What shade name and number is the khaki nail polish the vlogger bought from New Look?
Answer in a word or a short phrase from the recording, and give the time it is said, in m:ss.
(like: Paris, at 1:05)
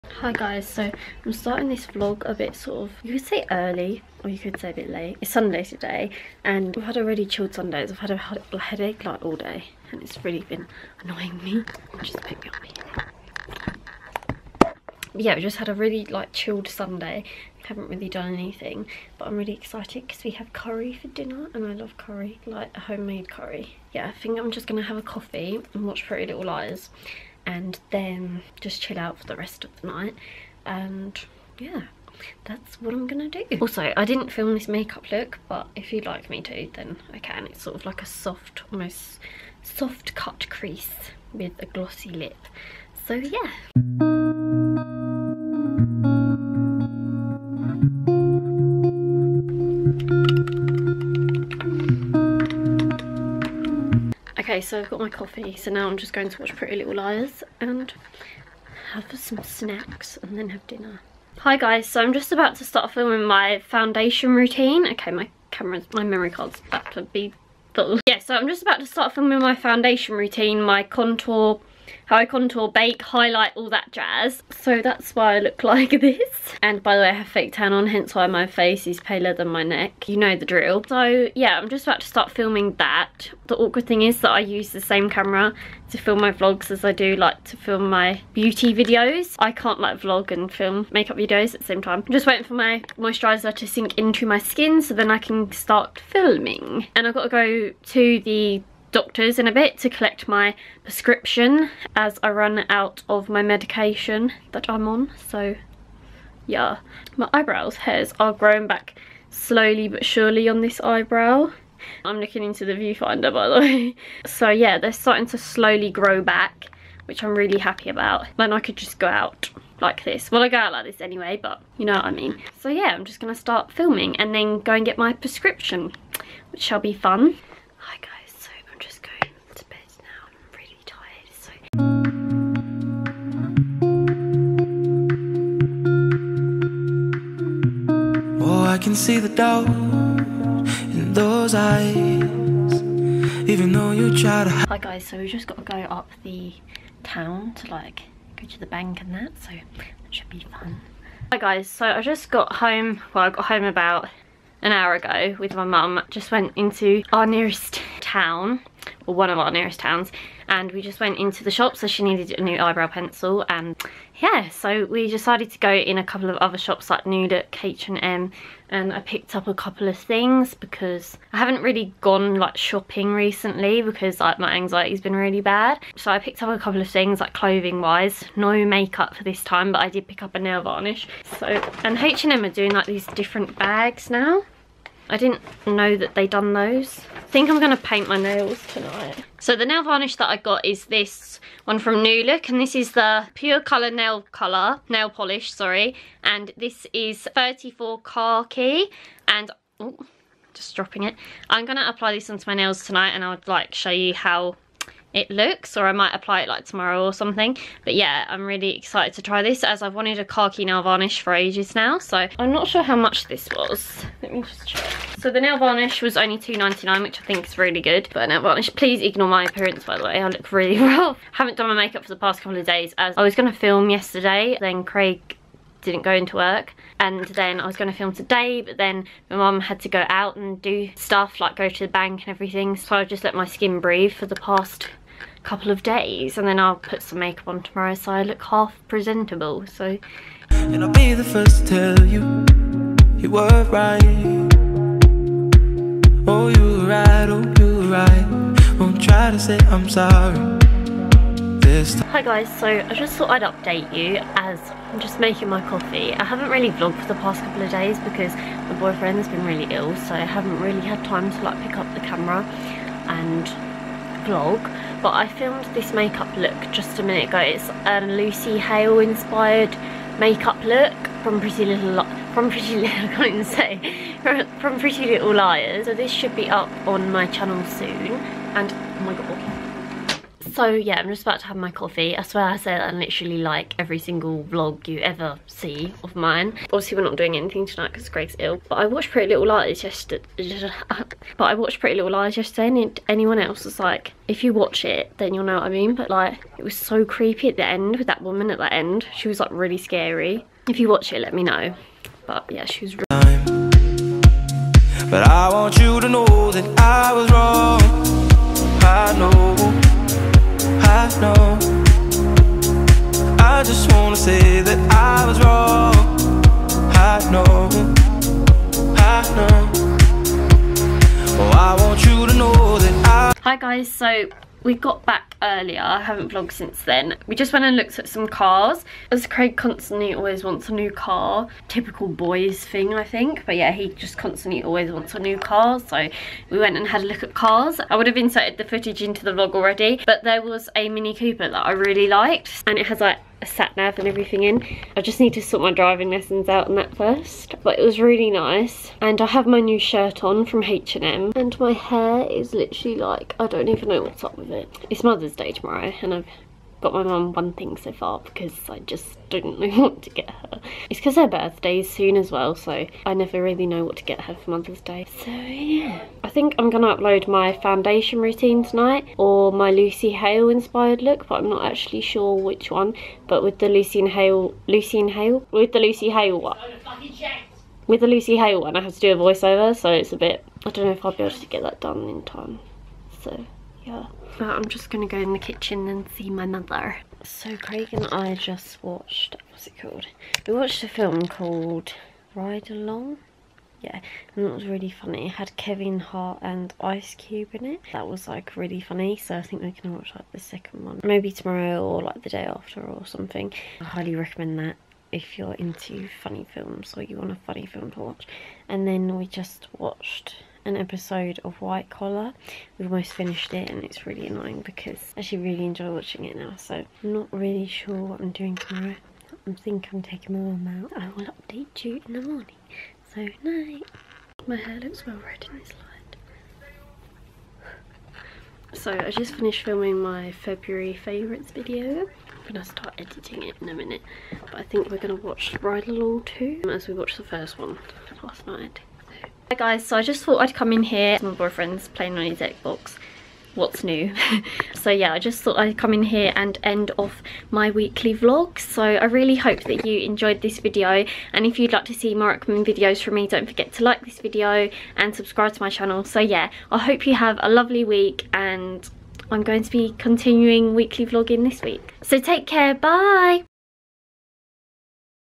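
34 Khaki, at 3:17.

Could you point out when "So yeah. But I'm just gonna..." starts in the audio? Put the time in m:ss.
6:23.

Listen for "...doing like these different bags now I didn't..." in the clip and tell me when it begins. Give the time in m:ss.
3:02.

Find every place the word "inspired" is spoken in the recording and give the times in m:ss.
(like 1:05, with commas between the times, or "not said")
4:28, 6:10.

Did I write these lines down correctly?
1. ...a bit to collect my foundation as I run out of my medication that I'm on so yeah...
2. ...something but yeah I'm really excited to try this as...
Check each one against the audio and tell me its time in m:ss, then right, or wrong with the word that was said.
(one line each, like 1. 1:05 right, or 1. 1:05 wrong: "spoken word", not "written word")
1. 1:39 wrong: "prescription", not "foundation"
2. 3:27 right.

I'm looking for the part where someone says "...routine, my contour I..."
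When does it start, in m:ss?
1:10.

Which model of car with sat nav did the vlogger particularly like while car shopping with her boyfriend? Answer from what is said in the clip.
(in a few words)
Mini Cooper.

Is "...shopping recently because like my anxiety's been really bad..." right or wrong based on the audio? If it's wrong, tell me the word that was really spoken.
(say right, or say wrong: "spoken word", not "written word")
right.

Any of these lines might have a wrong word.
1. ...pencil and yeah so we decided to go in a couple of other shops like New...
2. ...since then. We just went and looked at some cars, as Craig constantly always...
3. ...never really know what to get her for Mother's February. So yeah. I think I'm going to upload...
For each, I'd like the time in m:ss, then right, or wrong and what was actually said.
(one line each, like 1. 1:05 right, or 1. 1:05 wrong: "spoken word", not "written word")
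1. 2:42 right
2. 5:26 right
3. 6:03 wrong: "Day", not "February".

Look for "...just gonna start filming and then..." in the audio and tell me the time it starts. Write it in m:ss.
2:03.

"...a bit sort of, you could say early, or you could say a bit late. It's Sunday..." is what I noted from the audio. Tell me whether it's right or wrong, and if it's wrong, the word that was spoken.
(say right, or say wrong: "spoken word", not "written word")
right.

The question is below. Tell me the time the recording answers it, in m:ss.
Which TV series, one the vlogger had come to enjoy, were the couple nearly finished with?
6:51.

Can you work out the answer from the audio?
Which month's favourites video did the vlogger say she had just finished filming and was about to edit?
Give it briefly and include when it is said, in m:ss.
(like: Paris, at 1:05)
February, at 7:10.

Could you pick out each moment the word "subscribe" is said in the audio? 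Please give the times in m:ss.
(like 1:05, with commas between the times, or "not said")
7:35.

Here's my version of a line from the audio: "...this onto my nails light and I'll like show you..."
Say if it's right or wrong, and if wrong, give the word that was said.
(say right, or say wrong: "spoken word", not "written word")
wrong: "tonight", not "light".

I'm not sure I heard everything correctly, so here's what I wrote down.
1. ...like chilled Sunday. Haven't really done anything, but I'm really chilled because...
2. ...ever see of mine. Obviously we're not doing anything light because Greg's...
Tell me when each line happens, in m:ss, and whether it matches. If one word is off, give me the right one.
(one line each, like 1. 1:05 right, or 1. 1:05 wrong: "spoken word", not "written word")
1. 0:16 wrong: "excited", not "chilled"
2. 4:44 wrong: "tonight", not "light".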